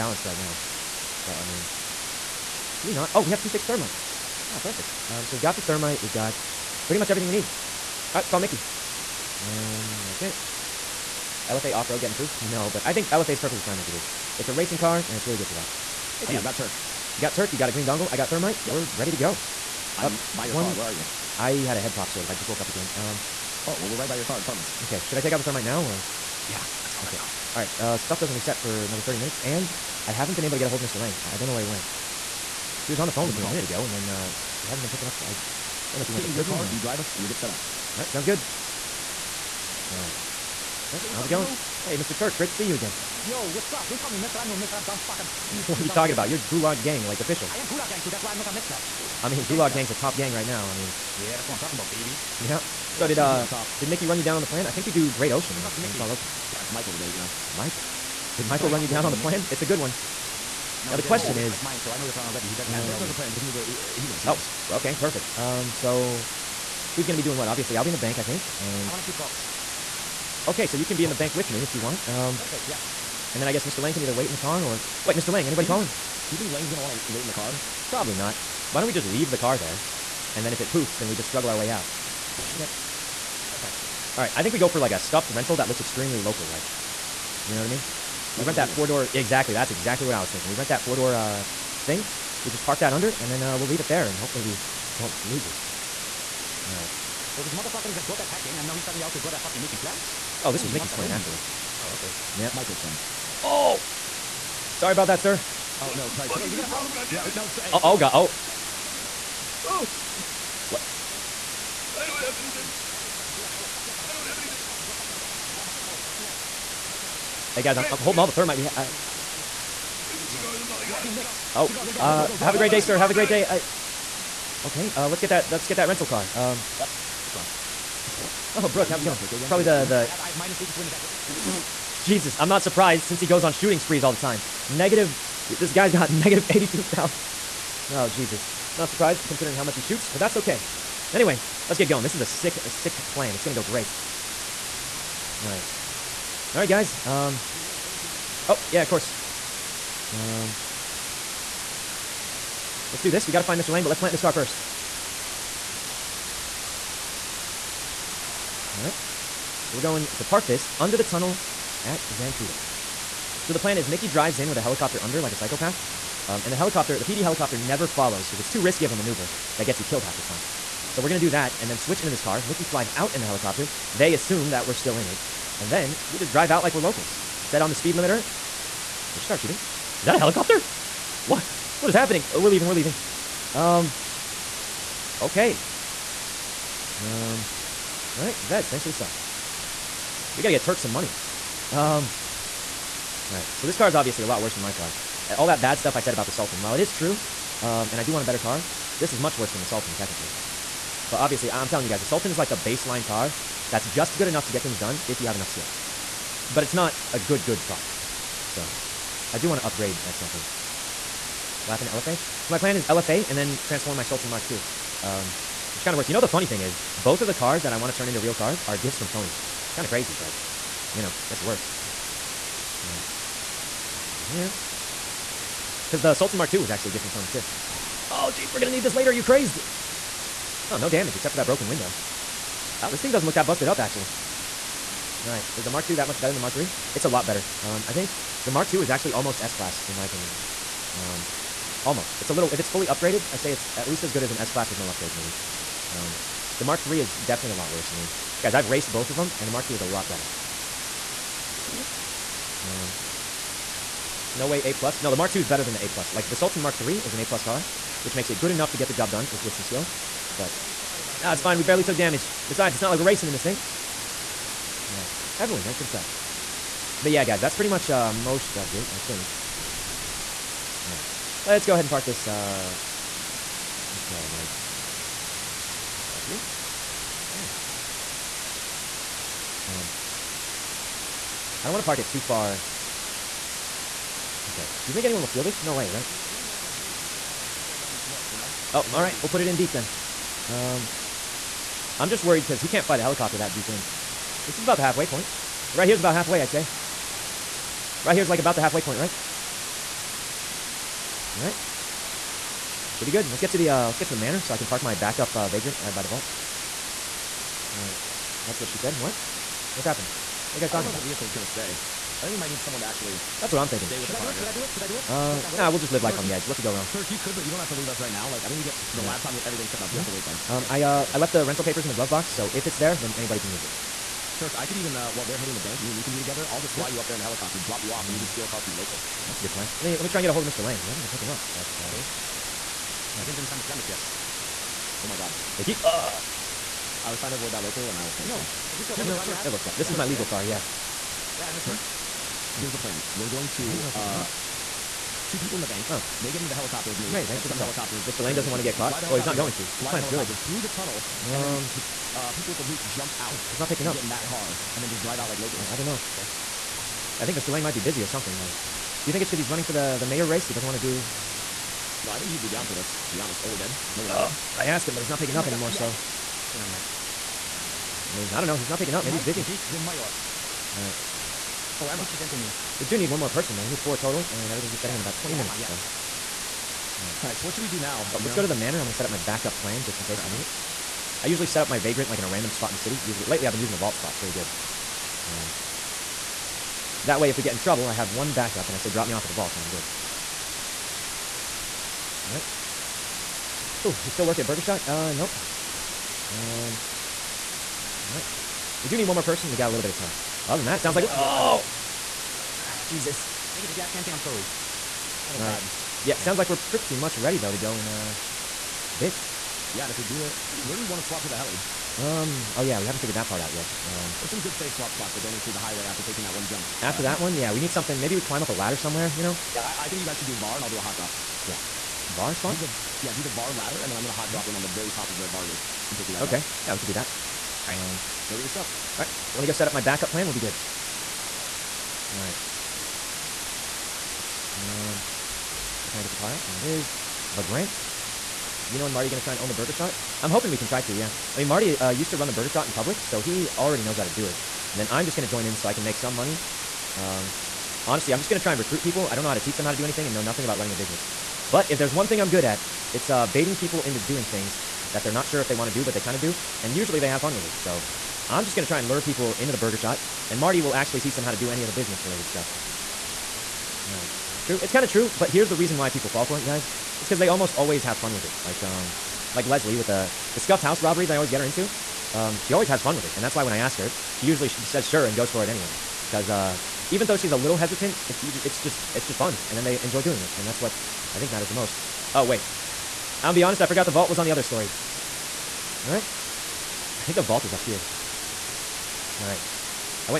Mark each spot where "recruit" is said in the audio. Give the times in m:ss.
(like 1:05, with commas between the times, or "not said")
7:28.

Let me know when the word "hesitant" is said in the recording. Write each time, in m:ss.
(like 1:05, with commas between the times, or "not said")
7:57.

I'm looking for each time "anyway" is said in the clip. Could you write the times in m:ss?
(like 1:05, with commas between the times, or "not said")
2:21, 7:55.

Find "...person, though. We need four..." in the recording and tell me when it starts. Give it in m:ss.
6:13.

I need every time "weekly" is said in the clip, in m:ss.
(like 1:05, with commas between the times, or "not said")
not said.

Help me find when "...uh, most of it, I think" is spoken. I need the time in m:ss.
4:27.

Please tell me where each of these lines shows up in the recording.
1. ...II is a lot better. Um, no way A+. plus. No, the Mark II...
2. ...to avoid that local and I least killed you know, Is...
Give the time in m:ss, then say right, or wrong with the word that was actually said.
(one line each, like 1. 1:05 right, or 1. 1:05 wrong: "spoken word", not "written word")
1. 4:09 right
2. 5:37 wrong: "almost", not "least".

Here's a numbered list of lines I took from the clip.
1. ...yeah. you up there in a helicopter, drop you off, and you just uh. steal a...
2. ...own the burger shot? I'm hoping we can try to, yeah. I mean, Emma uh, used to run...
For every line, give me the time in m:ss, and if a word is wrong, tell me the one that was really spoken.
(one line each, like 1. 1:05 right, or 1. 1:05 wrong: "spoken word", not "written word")
1. 5:26 right
2. 7:19 wrong: "Marty", not "Emma".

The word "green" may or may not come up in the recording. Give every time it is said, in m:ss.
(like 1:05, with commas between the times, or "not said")
0:17.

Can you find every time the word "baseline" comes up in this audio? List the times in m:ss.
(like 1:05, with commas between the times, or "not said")
3:22.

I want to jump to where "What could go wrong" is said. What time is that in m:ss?
5:16.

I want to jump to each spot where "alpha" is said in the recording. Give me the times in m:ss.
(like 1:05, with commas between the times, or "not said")
not said.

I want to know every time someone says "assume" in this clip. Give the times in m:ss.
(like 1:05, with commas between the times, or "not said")
2:54.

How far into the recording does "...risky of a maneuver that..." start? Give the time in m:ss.
2:48.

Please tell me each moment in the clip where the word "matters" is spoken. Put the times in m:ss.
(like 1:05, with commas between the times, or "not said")
8:01.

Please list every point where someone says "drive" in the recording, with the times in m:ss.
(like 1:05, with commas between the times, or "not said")
0:36, 2:44, 2:56, 5:55.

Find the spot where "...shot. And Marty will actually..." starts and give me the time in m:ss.
7:39.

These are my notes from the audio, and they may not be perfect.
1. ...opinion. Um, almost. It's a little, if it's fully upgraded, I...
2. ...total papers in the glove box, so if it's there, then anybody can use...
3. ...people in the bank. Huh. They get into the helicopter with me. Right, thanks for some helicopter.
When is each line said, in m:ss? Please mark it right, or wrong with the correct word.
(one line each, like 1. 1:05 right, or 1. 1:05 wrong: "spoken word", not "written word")
1. 4:00 right
2. 5:21 wrong: "rental", not "total"
3. 5:45 right.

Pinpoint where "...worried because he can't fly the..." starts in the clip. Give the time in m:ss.
4:52.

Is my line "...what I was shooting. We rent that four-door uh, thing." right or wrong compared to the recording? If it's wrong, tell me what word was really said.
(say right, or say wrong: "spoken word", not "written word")
wrong: "thinking", not "shooting".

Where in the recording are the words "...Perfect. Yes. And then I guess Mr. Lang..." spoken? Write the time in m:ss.
1:12.